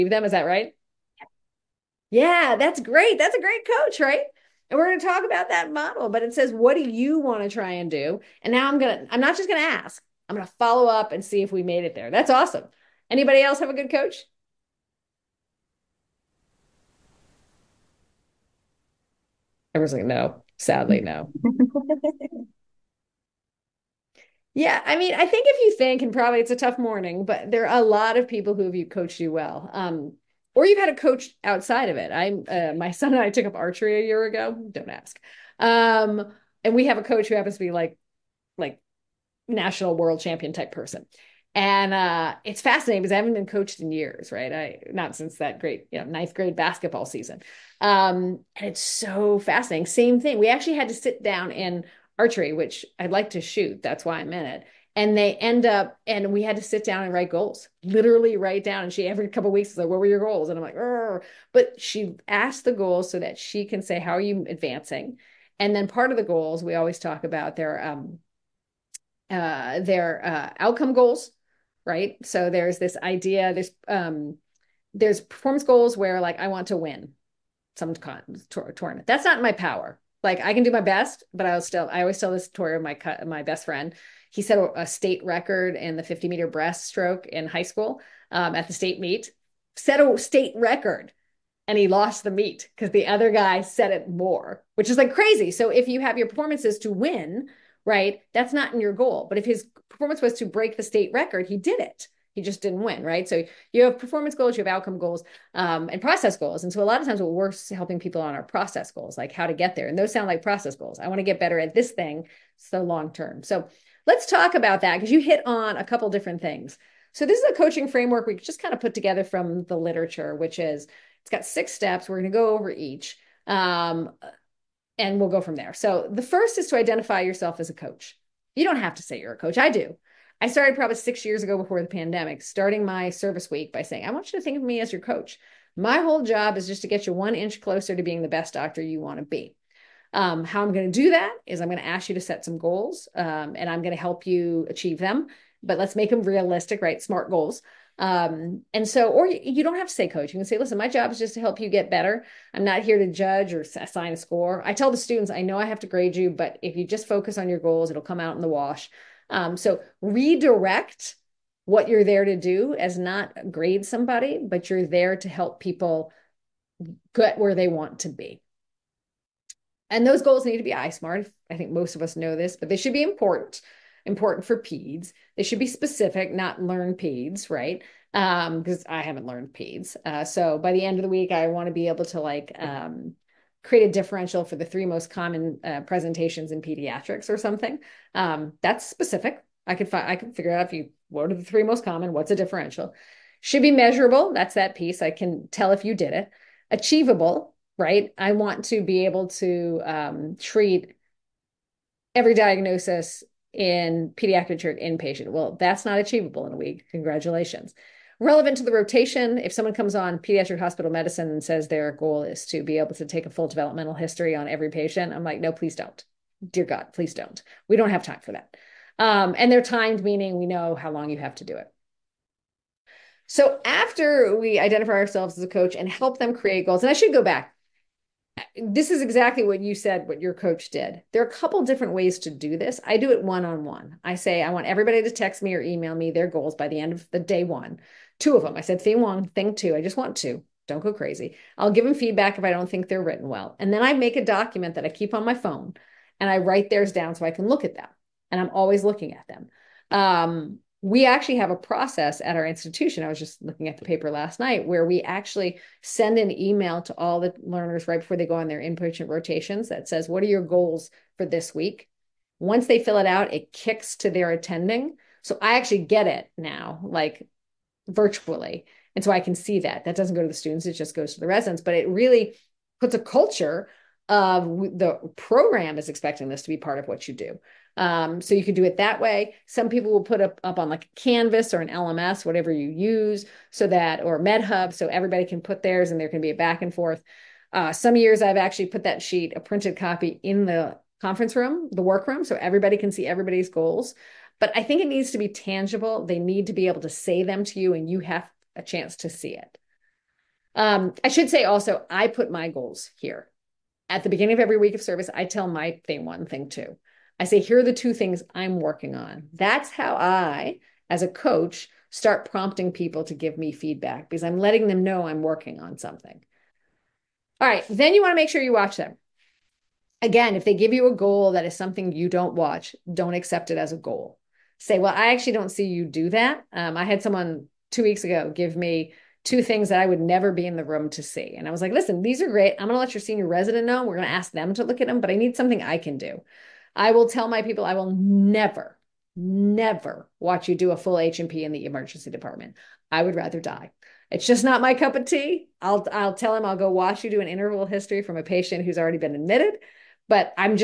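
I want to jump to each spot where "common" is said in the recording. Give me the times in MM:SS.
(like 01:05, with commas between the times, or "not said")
03:05, 03:11.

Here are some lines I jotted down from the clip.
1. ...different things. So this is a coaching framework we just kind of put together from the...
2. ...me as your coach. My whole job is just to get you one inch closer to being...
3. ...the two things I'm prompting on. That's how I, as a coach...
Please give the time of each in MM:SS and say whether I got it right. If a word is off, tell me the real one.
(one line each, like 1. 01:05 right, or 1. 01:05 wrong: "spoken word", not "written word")
1. 01:56 right
2. 02:14 right
3. 05:07 wrong: "working", not "prompting".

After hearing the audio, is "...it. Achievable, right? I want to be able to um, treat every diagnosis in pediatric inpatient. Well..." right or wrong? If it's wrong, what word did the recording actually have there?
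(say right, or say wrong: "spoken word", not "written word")
right.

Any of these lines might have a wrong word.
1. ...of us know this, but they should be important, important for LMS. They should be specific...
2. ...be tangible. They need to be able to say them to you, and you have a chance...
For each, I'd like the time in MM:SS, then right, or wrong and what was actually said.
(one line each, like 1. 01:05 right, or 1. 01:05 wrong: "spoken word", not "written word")
1. 02:51 wrong: "PEDS", not "LMS"
2. 04:55 right.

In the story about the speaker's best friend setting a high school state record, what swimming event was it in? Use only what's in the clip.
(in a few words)
50 meter breaststroke.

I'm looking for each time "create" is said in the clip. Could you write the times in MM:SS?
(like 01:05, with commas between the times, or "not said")
03:03, 03:46.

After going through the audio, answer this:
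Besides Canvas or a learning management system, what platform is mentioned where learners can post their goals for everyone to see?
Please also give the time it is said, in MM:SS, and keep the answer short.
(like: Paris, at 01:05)
MedHub, at 04:44.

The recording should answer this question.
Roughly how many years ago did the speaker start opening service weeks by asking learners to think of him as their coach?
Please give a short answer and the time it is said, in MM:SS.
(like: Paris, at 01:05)
6, at 02:10.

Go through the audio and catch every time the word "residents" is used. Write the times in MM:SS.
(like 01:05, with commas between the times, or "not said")
04:31, 05:33.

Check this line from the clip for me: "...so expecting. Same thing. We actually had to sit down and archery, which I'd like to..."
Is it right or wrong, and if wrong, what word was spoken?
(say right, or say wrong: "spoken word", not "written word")
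wrong: "fascinating", not "expecting".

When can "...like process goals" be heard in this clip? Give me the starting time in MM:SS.
01:50.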